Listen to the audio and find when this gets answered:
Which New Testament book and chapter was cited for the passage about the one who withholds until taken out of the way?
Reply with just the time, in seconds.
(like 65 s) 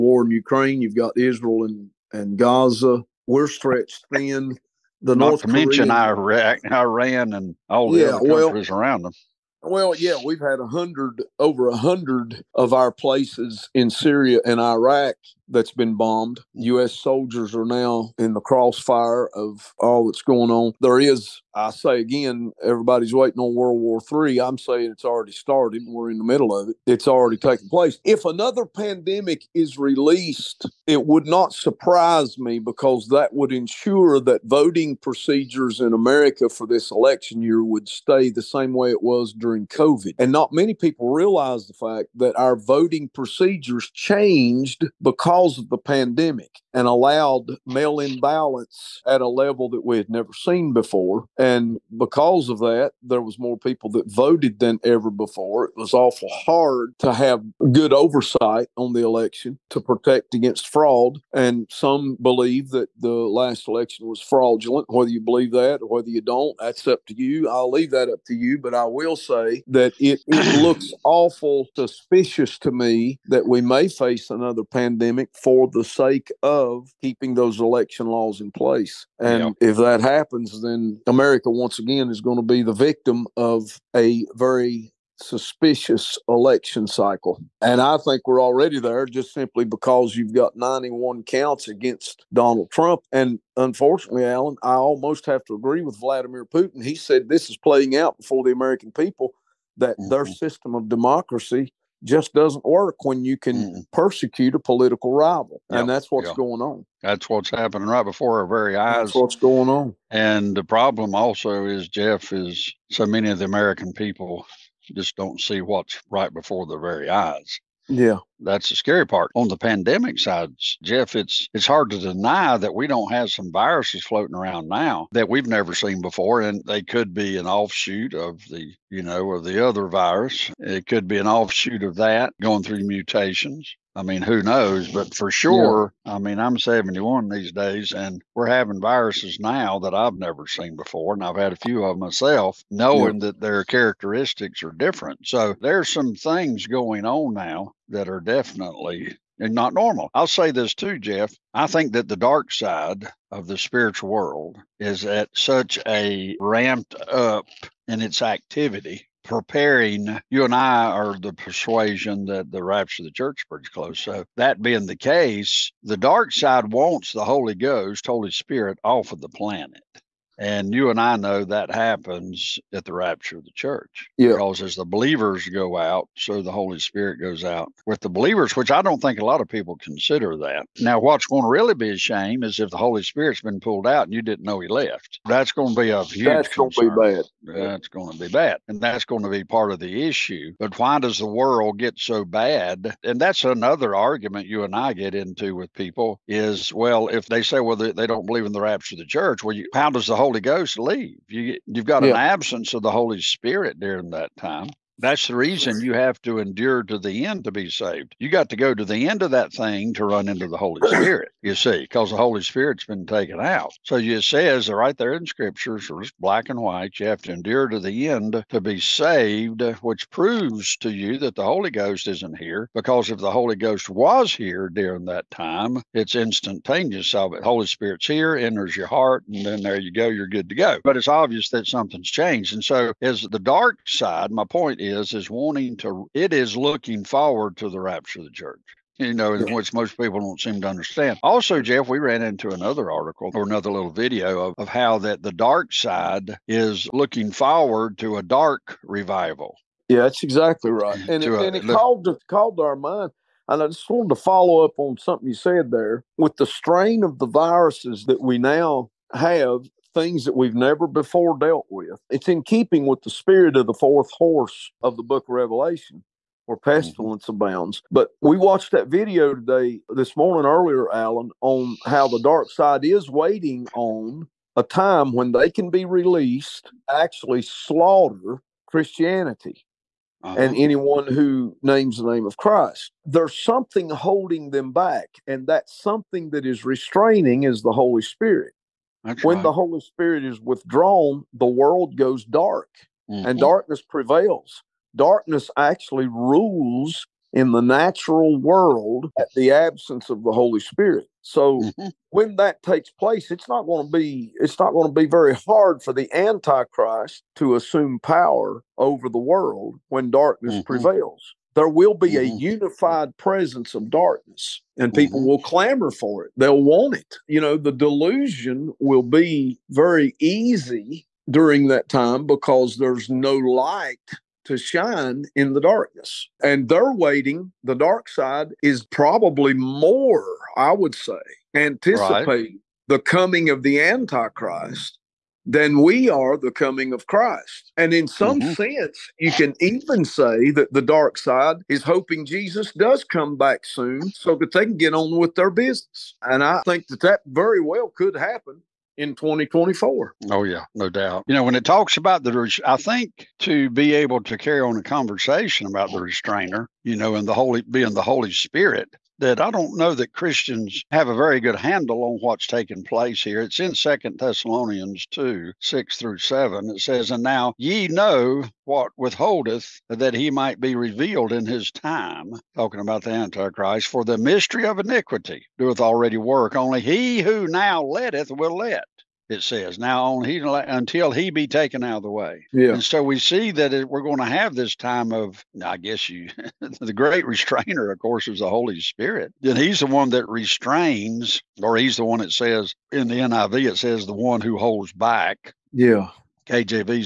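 363 s.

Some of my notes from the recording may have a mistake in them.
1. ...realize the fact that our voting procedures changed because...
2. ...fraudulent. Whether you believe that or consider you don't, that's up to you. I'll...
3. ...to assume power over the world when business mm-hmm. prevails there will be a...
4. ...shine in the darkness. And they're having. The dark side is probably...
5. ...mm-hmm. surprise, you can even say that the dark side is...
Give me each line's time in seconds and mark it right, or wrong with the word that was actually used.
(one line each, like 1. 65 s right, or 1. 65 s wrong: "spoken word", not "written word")
1. 41 s right
2. 64 s wrong: "whether", not "consider"
3. 307 s wrong: "darkness", not "business"
4. 324 s wrong: "waiting", not "having"
5. 338 s wrong: "sense", not "surprise".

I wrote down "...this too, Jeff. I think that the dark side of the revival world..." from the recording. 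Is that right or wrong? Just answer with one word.
wrong.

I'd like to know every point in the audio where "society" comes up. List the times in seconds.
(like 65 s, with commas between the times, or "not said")
not said.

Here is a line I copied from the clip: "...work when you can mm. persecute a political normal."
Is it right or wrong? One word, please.
wrong.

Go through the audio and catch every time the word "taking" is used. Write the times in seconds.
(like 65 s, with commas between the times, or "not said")
27 s, 362 s.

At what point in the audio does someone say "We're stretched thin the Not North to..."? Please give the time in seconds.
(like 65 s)
3 s.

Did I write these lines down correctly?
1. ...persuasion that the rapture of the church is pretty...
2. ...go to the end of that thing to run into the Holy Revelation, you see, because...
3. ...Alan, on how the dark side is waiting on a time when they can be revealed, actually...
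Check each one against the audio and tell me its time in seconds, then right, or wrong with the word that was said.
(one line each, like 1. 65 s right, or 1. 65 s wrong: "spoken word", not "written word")
1. 161 s right
2. 208 s wrong: "Spirit", not "Revelation"
3. 270 s wrong: "released", not "revealed".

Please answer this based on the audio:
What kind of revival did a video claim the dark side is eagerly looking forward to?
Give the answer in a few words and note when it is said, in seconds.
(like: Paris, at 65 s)
A dark revival, at 248 s.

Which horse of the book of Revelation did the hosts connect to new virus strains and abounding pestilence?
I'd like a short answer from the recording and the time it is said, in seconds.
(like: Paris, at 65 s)
The fourth horse, at 263 s.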